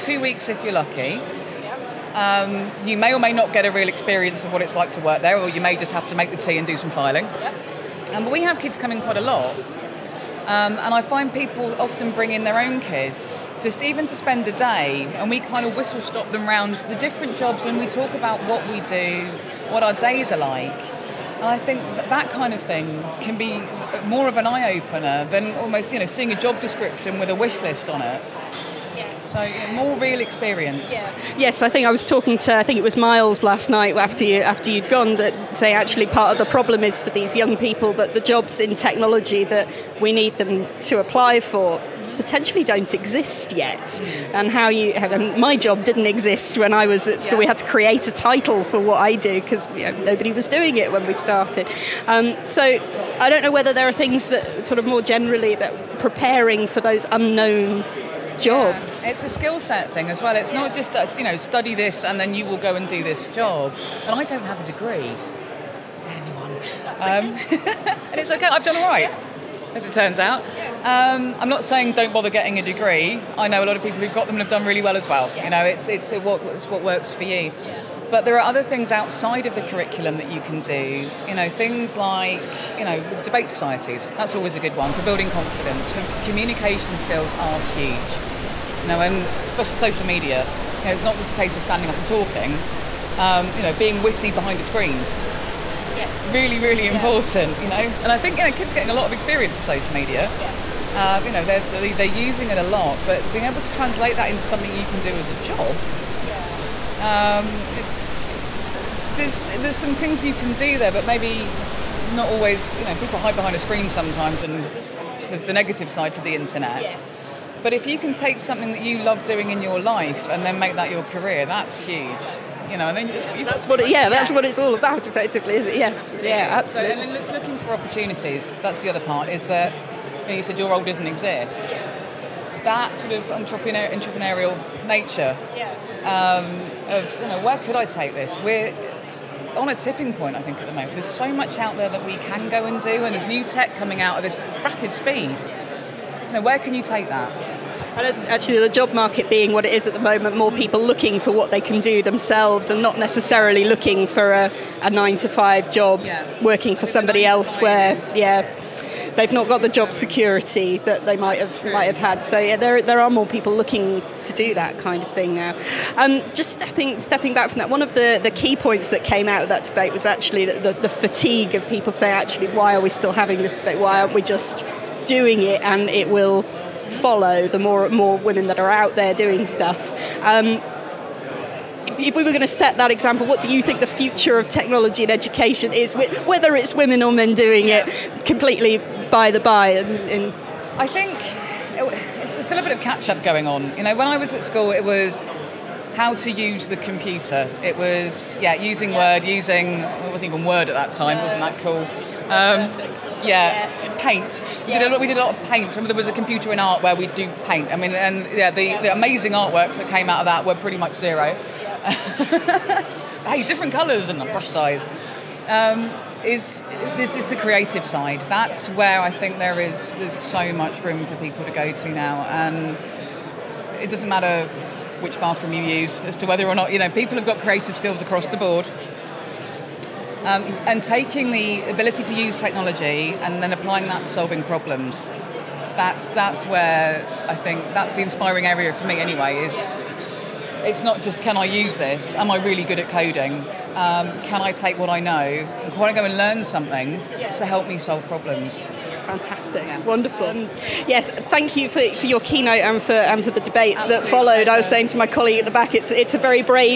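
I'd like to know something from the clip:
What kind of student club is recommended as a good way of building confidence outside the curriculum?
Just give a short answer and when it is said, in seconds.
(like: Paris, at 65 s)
debate societies, at 83 s.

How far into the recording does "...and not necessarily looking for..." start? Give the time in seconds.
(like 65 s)
152 s.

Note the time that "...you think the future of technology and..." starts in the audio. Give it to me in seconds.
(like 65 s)
183 s.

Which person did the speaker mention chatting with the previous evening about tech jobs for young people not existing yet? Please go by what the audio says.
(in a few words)
Miles.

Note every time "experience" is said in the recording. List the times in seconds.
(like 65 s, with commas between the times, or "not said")
3 s, 30 s, 99 s.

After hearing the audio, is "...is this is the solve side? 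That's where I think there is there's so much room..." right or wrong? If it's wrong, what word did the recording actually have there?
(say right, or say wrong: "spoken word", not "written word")
wrong: "creative", not "solve".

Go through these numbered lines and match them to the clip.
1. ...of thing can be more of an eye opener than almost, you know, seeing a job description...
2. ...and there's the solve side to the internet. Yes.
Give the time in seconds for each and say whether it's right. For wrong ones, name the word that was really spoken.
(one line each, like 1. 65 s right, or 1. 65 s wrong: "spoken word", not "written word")
1. 22 s right
2. 114 s wrong: "negative", not "solve".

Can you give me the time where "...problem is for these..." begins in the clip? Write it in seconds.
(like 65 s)
36 s.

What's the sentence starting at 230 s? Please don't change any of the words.
Um, and taking the ability to use technology and then applying that to solving problems.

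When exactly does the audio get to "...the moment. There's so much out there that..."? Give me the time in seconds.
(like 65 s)
140 s.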